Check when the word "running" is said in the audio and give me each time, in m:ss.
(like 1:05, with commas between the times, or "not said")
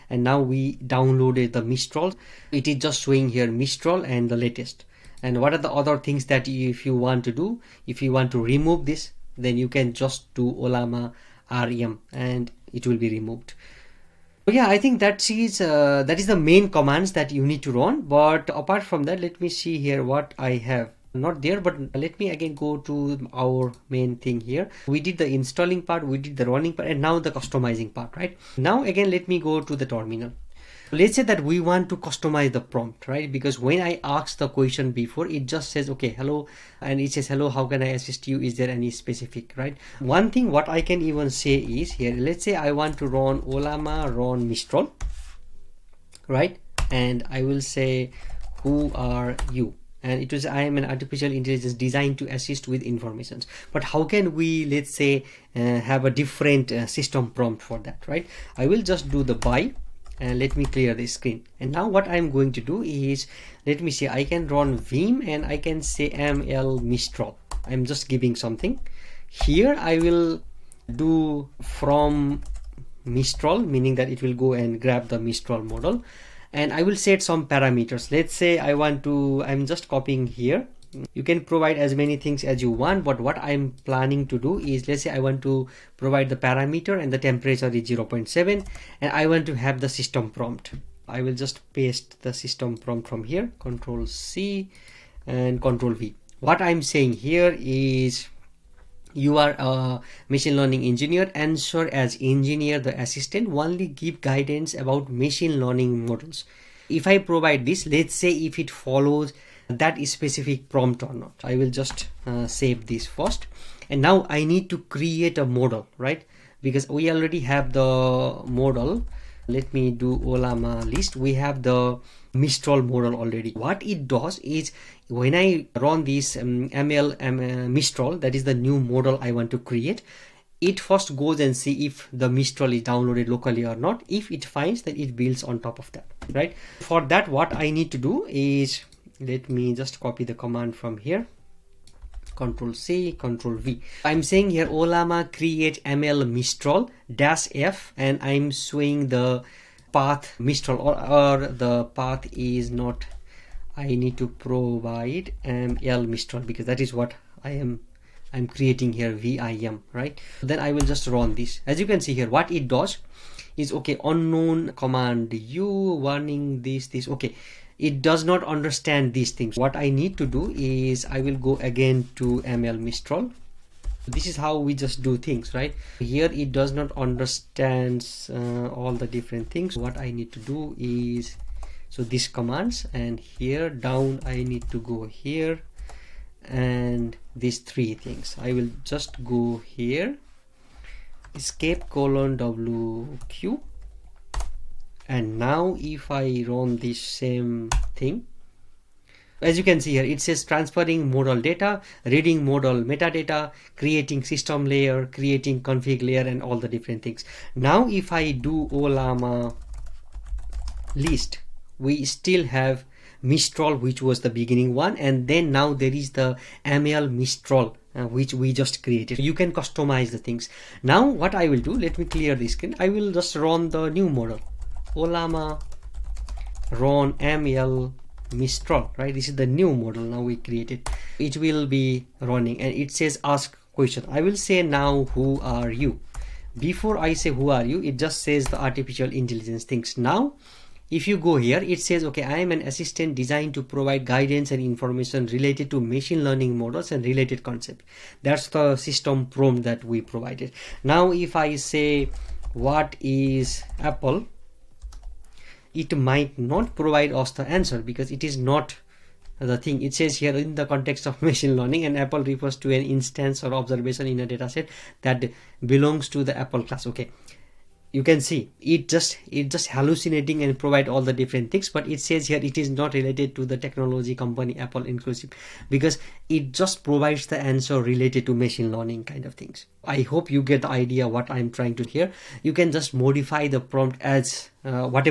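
0:26, 3:52.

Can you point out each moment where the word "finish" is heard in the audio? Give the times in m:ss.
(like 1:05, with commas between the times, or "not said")
not said.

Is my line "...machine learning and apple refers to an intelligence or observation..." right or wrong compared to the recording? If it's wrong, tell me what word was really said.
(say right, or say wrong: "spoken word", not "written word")
wrong: "instance", not "intelligence".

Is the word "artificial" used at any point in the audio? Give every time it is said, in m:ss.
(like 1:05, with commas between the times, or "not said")
0:50, 3:58.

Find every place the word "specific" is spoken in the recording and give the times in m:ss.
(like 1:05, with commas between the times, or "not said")
0:38, 1:50.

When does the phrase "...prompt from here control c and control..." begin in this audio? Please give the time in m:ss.
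1:32.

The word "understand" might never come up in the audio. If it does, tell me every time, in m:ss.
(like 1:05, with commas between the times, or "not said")
2:48, 2:56.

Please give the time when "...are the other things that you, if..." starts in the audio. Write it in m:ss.
0:05.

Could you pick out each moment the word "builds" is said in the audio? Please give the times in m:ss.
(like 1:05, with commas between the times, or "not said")
2:15.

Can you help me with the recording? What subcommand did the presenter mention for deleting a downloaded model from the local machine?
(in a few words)
ollama rem.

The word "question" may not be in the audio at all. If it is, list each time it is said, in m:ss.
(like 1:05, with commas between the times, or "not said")
0:34, 3:53.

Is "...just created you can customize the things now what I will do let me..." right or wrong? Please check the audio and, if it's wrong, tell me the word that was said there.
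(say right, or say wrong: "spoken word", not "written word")
right.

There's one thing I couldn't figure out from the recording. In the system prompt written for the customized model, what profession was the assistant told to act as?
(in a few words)
machine learning engineer.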